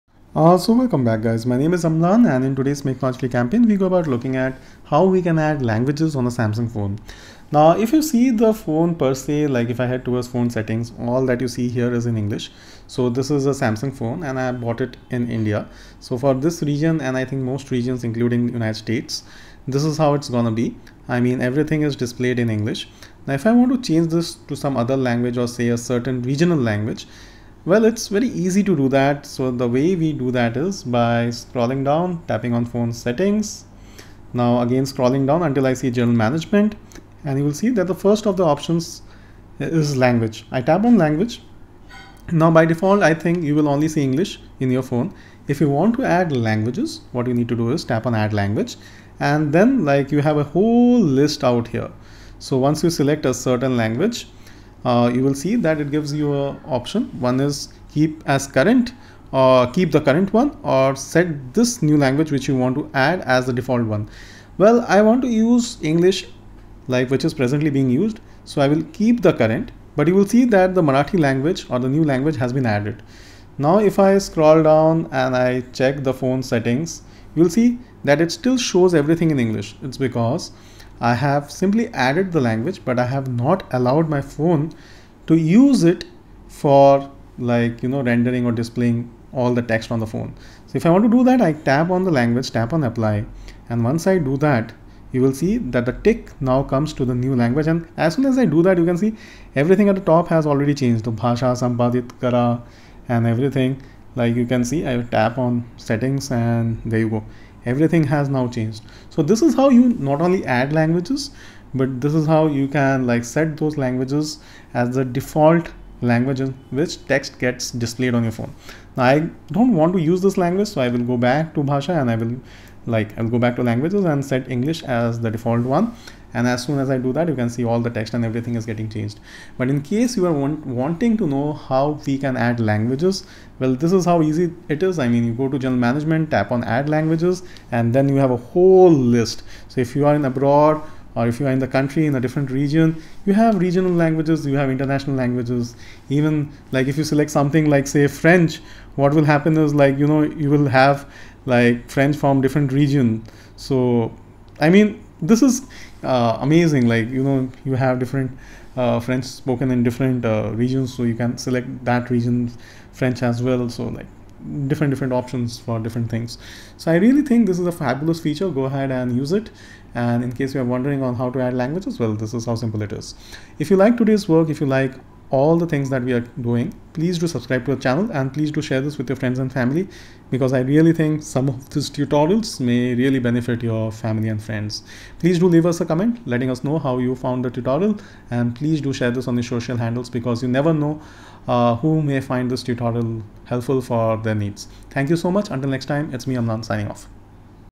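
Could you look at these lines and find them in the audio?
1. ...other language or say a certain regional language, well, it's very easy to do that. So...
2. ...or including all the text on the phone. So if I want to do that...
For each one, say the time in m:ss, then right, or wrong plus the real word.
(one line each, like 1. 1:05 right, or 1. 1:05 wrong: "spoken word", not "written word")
1. 0:24 right
2. 1:28 wrong: "displaying", not "including".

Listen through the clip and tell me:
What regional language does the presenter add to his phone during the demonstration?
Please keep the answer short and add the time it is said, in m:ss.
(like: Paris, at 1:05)
Marathi, at 1:10.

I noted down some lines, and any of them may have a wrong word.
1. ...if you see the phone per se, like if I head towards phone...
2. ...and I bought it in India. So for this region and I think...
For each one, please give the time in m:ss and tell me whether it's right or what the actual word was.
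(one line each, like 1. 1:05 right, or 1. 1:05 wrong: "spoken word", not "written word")
1. 0:07 right
2. 0:14 right.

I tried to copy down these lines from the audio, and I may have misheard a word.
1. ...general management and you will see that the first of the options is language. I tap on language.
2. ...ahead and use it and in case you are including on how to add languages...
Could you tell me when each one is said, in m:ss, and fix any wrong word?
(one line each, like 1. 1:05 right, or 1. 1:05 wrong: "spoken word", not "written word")
1. 0:35 right
2. 2:48 wrong: "wondering", not "including".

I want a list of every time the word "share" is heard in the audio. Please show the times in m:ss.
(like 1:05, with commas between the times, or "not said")
2:58, 3:08.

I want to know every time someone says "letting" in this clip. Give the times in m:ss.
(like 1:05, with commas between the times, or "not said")
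3:06.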